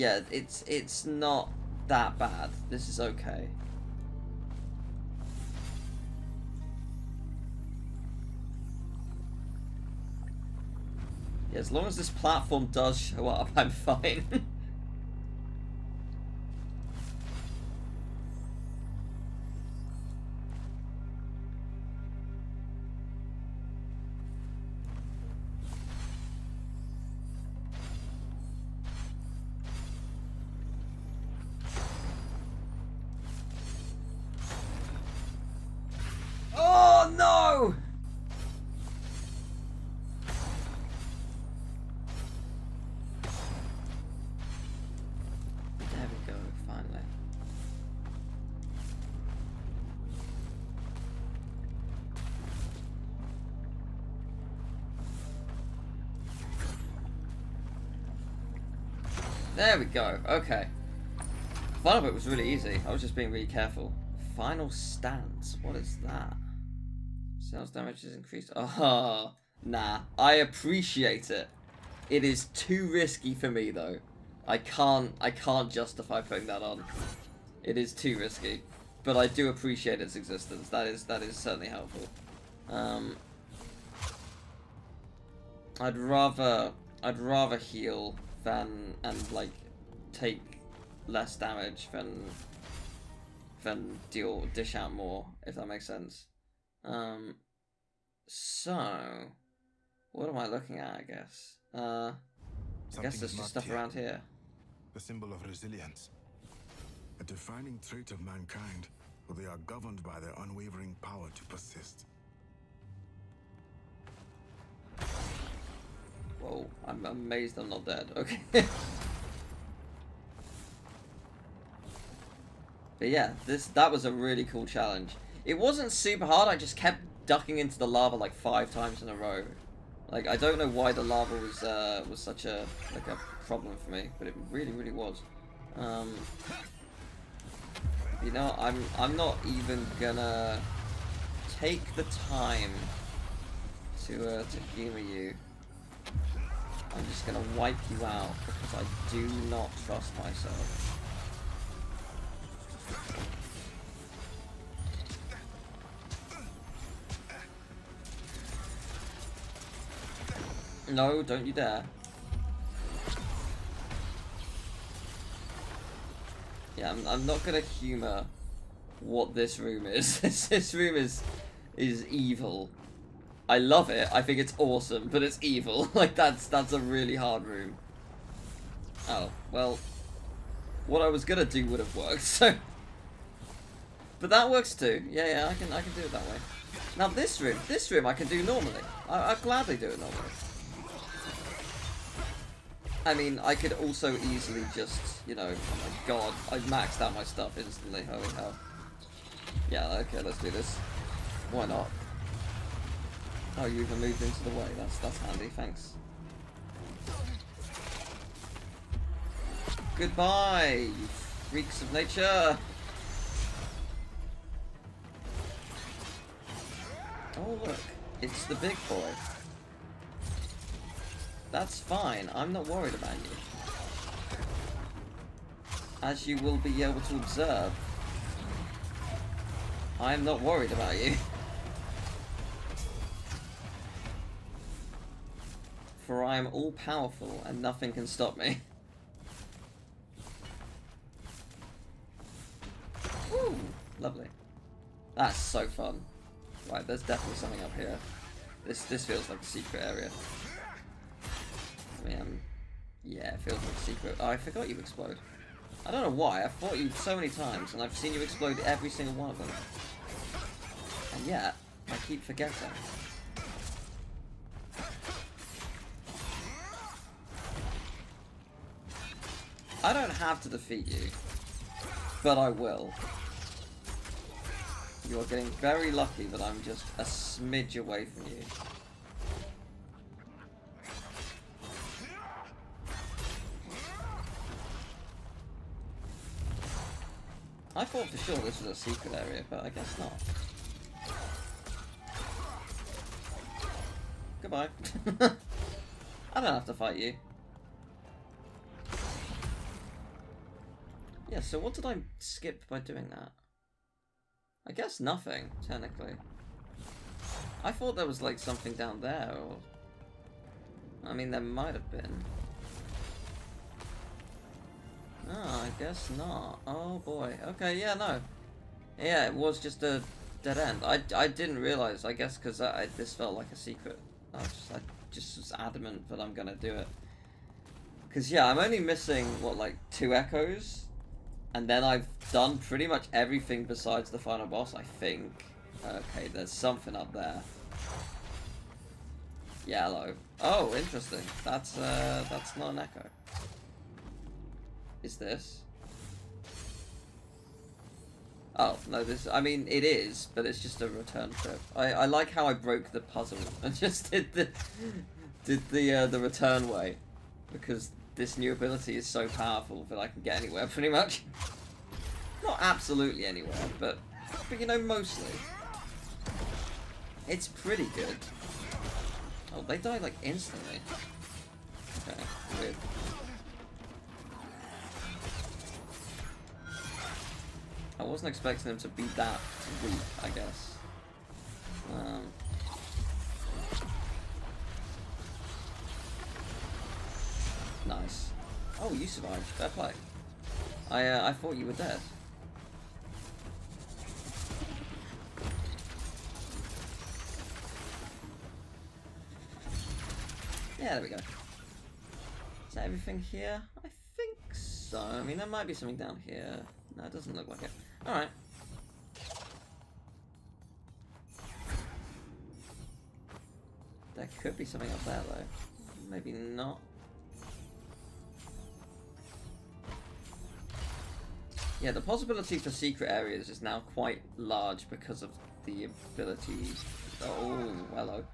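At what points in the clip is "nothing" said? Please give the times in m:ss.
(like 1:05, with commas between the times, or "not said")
3:57, 5:04.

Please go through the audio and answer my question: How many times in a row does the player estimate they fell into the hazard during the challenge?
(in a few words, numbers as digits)
5.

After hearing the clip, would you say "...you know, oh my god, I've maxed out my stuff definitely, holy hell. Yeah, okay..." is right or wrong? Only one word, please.
wrong.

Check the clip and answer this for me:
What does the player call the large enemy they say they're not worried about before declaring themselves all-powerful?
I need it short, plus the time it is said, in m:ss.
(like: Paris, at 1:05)
The big boy, at 3:38.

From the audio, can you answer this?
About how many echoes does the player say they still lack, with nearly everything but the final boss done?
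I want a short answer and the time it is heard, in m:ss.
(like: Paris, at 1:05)
2, at 5:29.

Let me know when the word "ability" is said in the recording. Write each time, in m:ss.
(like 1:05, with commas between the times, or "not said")
5:58, 7:05.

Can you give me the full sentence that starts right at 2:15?
Um, you know, I'm I'm not even gonna take the time to uh, to humor you.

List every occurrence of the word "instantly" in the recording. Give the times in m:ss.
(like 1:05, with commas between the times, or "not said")
3:17, 6:10.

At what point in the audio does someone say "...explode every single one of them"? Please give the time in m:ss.
4:18.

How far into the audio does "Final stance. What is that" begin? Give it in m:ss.
1:04.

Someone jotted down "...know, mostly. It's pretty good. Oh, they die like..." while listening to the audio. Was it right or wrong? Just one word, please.
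right.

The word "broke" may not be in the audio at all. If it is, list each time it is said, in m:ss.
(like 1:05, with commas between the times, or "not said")
5:52.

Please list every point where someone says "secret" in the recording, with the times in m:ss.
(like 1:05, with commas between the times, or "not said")
4:09, 4:13, 4:48, 5:23, 7:02.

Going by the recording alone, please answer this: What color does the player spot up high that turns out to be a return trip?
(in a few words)
Yellow.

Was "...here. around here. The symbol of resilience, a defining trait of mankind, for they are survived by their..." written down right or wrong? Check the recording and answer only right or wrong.
wrong.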